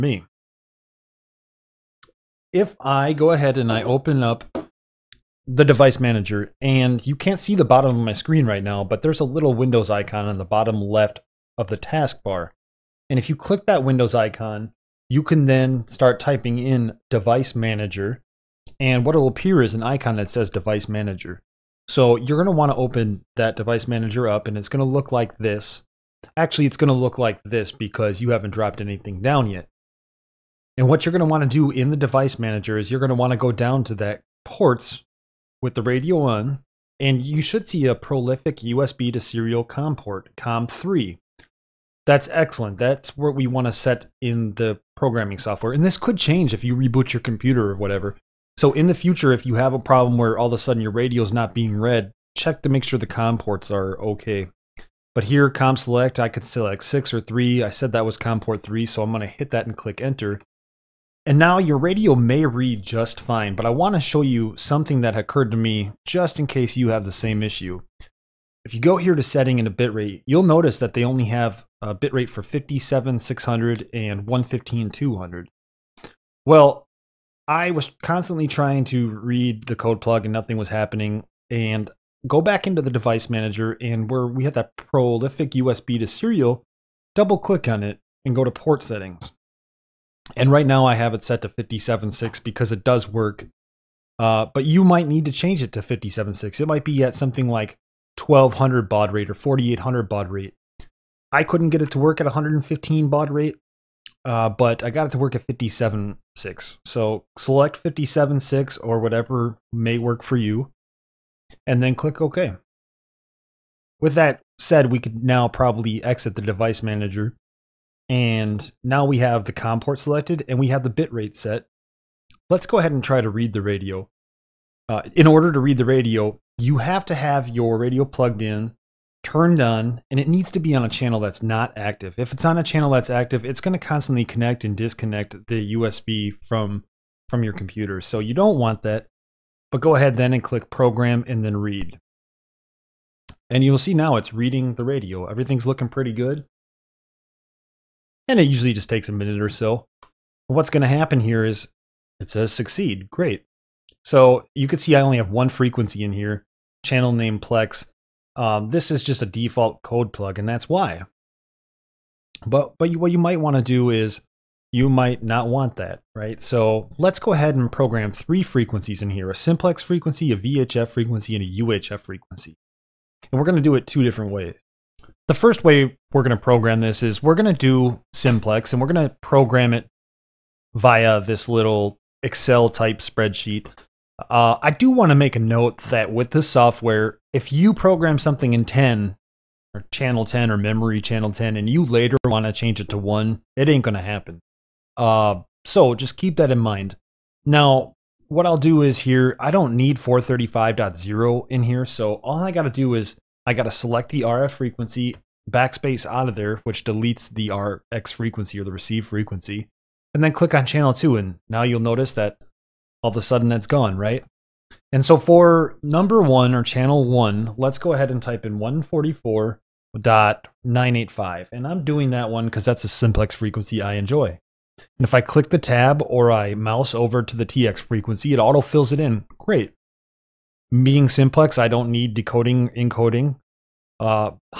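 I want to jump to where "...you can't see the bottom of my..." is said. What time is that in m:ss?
0:07.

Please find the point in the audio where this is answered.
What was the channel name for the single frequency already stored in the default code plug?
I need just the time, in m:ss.
2:37.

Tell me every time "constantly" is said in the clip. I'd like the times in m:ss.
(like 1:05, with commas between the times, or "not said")
1:18, 2:13.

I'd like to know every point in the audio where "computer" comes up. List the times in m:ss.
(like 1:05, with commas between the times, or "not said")
0:47, 2:17.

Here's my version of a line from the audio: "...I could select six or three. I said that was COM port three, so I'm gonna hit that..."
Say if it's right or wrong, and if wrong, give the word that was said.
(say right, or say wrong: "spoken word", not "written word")
right.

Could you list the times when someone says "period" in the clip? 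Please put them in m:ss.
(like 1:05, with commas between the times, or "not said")
not said.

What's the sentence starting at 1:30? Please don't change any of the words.
And right now I have it set to 57.6 because it does work.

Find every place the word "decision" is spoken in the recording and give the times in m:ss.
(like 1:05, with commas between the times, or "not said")
not said.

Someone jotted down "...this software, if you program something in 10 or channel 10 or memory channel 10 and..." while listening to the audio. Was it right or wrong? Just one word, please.
right.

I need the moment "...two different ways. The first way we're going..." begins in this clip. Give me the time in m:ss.
2:53.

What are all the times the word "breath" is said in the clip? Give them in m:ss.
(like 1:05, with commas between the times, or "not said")
not said.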